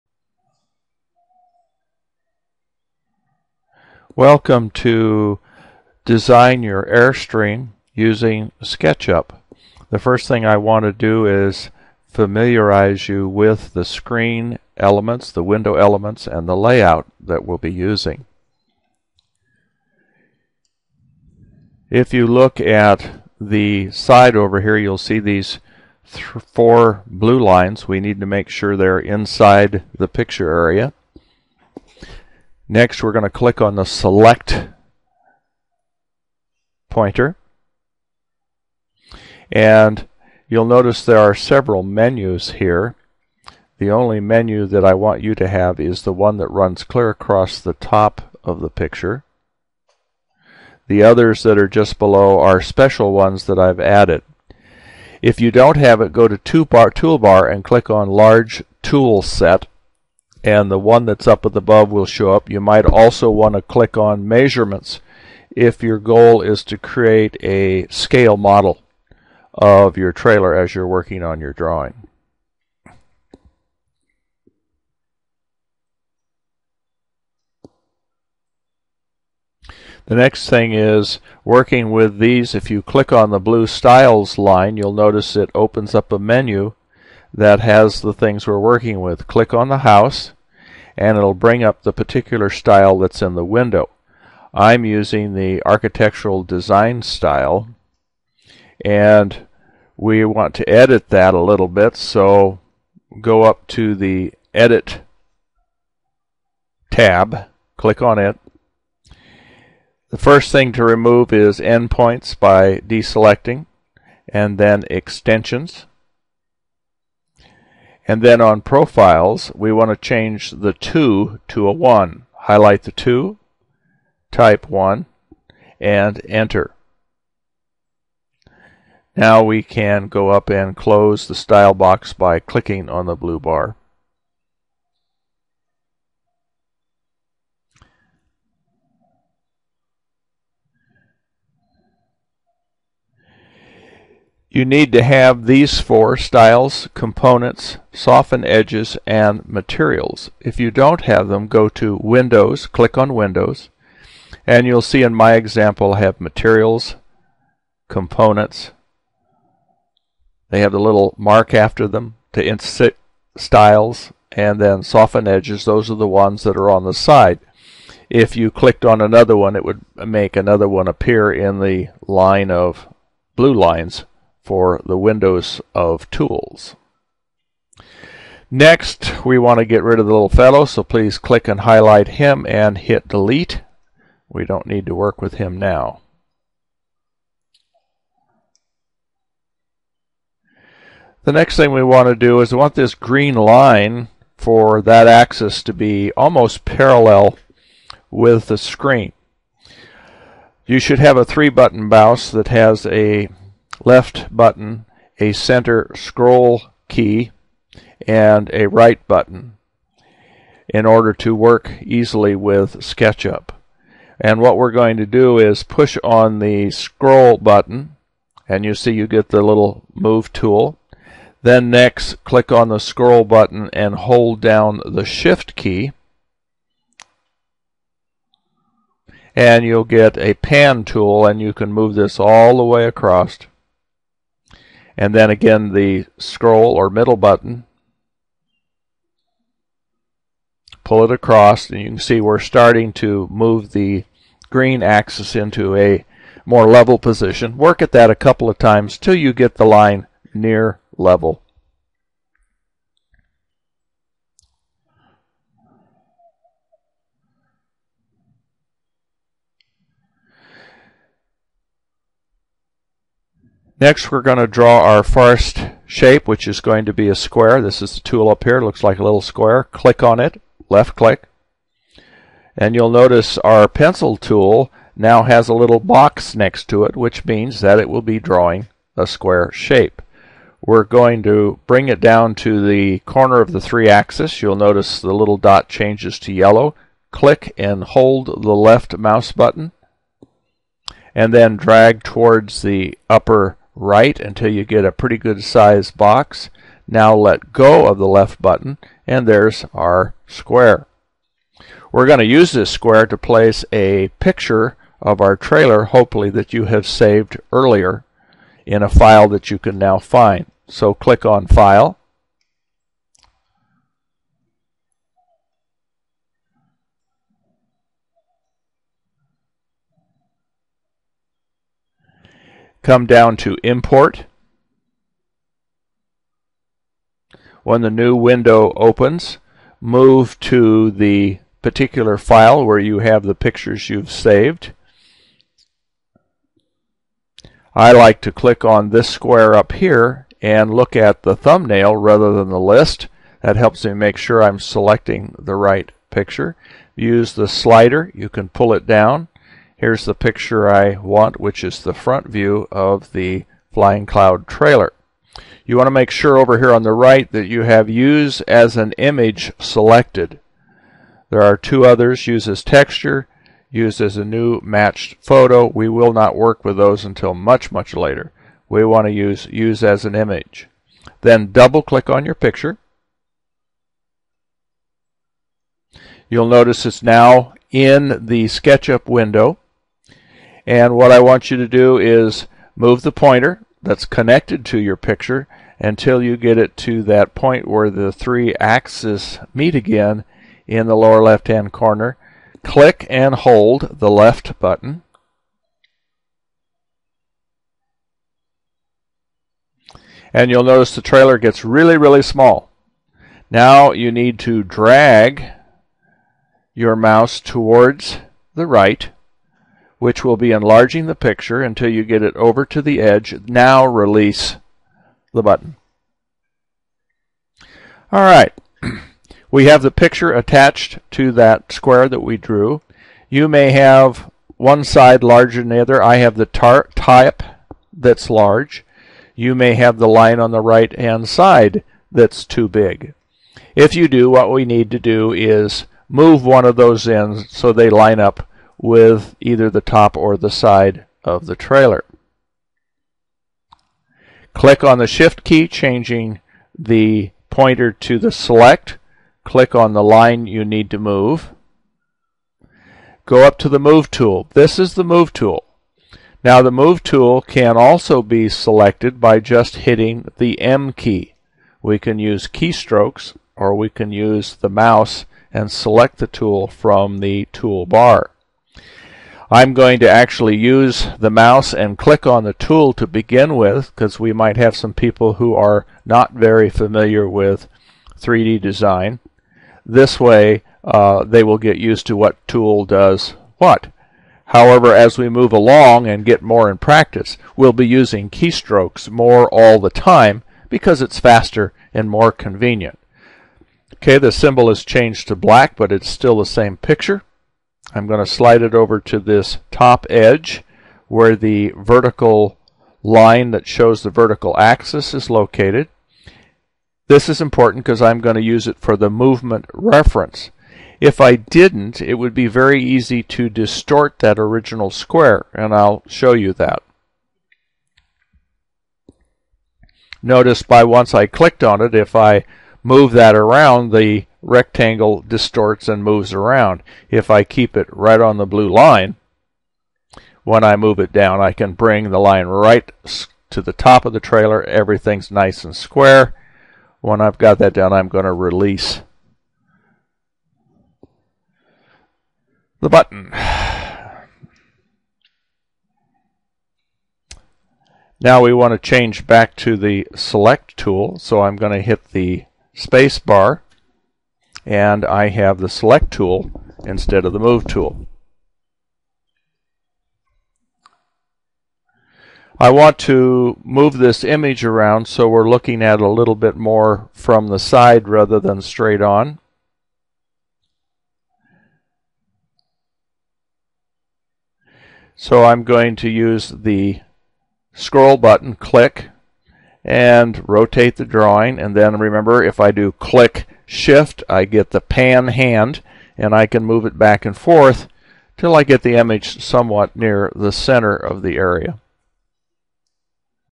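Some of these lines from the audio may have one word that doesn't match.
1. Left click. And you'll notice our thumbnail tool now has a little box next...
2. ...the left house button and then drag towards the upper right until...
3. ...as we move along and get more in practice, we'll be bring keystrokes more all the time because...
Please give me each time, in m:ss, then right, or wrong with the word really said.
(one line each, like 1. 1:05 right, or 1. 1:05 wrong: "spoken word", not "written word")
1. 4:30 wrong: "pencil", not "thumbnail"
2. 4:48 wrong: "mouse", not "house"
3. 8:04 wrong: "using", not "bring".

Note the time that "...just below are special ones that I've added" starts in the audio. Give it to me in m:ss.
0:51.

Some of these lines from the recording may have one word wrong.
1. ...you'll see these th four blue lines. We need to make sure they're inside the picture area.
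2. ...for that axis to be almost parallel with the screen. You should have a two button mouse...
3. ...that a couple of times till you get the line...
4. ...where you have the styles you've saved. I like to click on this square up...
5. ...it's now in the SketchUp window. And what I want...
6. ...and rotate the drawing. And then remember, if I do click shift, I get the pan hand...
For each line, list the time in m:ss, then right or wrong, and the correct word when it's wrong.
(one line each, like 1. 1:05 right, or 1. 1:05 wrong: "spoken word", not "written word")
1. 0:24 right
2. 3:14 wrong: "three", not "two"
3. 4:07 right
4. 5:32 wrong: "pictures", not "styles"
5. 6:16 right
6. 9:39 right.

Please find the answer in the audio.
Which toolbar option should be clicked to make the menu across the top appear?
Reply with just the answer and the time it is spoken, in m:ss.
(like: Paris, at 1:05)
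Large Tool Set, at 0:58.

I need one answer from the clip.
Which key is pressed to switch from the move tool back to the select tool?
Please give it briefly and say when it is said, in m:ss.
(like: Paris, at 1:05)
Space bar, at 9:12.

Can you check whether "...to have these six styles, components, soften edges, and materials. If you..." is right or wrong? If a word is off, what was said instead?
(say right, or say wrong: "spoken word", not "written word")
wrong: "four", not "six".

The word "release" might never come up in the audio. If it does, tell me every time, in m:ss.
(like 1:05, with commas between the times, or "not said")
6:53, 8:58.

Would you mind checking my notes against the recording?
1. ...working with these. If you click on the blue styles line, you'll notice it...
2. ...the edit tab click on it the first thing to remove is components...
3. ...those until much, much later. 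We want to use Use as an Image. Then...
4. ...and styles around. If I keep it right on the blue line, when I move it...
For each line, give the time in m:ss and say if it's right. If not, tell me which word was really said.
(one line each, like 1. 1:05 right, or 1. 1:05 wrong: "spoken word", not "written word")
1. 1:21 right
2. 1:43 wrong: "endpoints", not "components"
3. 6:06 right
4. 8:45 wrong: "moves", not "styles".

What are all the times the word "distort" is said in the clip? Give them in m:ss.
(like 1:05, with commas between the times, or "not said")
8:33, 8:45.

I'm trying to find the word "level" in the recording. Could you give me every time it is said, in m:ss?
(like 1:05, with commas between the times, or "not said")
4:06, 4:10.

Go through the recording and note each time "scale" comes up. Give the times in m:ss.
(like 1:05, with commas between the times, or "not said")
1:07.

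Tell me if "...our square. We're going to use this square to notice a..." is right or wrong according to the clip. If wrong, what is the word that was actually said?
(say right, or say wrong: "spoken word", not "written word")
wrong: "place", not "notice".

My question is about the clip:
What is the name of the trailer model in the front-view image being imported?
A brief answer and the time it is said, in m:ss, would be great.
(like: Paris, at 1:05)
Flying Cloud, at 5:53.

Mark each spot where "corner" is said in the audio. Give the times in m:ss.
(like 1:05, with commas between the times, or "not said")
4:42, 6:31.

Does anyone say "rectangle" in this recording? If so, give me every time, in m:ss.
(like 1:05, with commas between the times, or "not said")
8:44.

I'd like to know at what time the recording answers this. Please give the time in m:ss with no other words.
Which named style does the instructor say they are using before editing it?
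1:35.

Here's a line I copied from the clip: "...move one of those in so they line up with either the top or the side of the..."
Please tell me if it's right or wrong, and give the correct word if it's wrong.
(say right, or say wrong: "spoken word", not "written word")
right.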